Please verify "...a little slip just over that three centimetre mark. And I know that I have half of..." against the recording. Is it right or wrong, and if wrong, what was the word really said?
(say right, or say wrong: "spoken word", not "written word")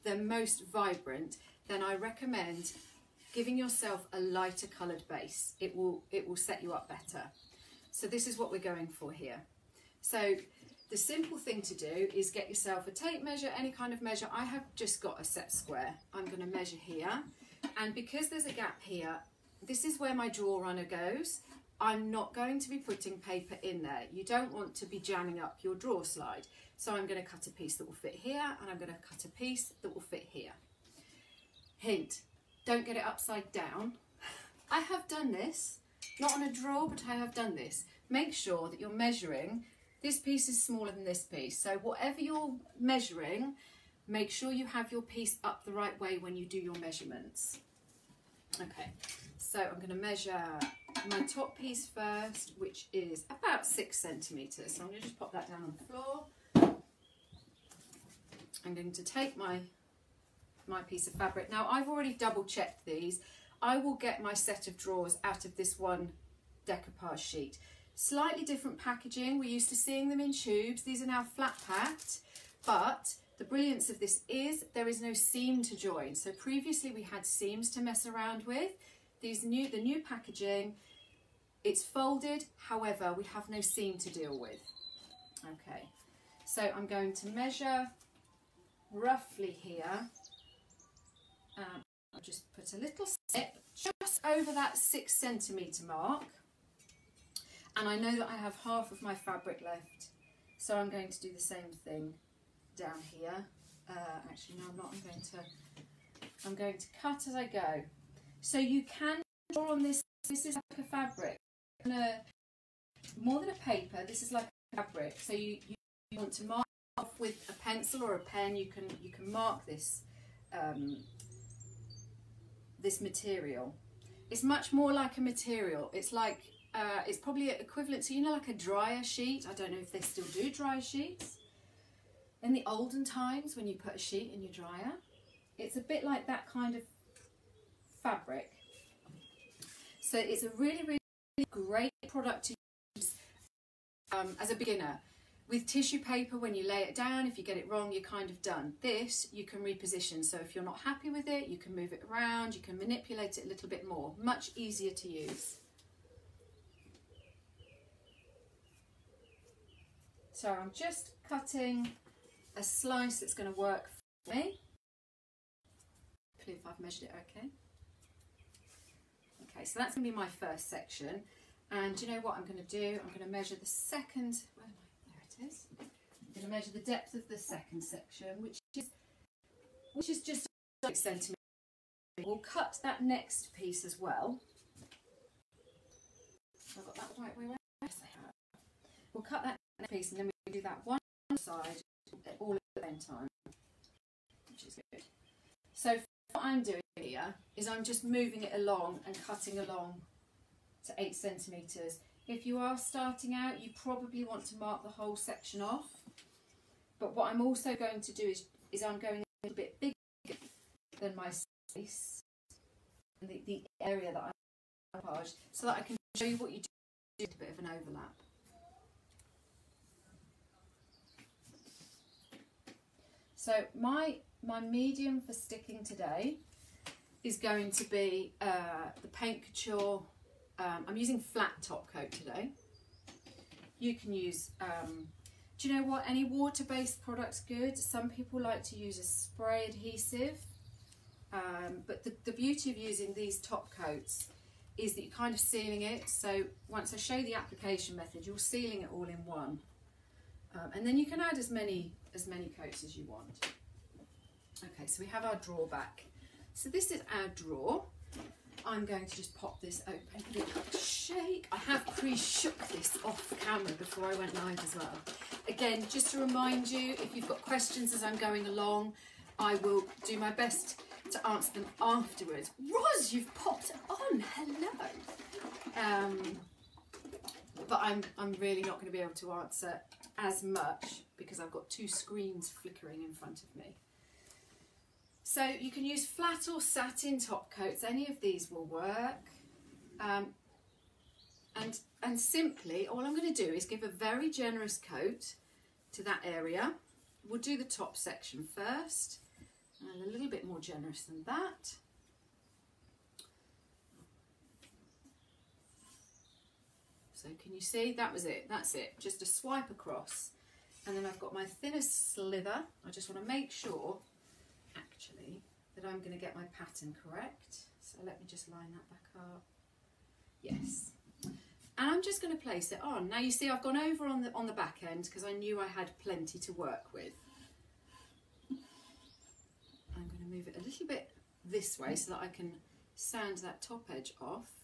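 wrong: "six", not "three".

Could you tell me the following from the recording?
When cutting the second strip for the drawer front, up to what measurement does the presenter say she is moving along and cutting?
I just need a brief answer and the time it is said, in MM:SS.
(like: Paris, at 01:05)
8 centimetres, at 03:20.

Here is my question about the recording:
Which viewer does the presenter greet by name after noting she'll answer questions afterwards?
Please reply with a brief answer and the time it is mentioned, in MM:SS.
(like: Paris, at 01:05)
Roz, at 04:32.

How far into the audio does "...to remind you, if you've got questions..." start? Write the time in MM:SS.
04:26.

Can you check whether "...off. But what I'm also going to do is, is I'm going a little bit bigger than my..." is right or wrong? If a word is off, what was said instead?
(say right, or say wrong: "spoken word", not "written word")
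right.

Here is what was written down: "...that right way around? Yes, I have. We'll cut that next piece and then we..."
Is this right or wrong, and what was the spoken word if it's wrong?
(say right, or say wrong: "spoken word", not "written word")
right.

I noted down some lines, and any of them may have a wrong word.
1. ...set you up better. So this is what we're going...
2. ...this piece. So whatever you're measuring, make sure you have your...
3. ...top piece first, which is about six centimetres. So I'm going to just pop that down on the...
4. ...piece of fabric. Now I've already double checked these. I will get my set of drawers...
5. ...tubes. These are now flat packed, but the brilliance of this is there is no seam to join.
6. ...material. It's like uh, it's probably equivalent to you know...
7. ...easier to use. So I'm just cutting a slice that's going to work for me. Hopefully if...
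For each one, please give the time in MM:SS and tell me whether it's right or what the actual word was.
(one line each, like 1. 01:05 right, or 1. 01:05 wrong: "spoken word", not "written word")
1. 00:06 right
2. 00:41 right
3. 00:51 right
4. 01:00 right
5. 01:10 right
6. 02:05 right
7. 02:34 right.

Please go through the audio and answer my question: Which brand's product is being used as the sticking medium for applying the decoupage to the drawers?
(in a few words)
Paint Couture.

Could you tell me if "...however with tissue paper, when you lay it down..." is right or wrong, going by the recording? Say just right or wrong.
wrong.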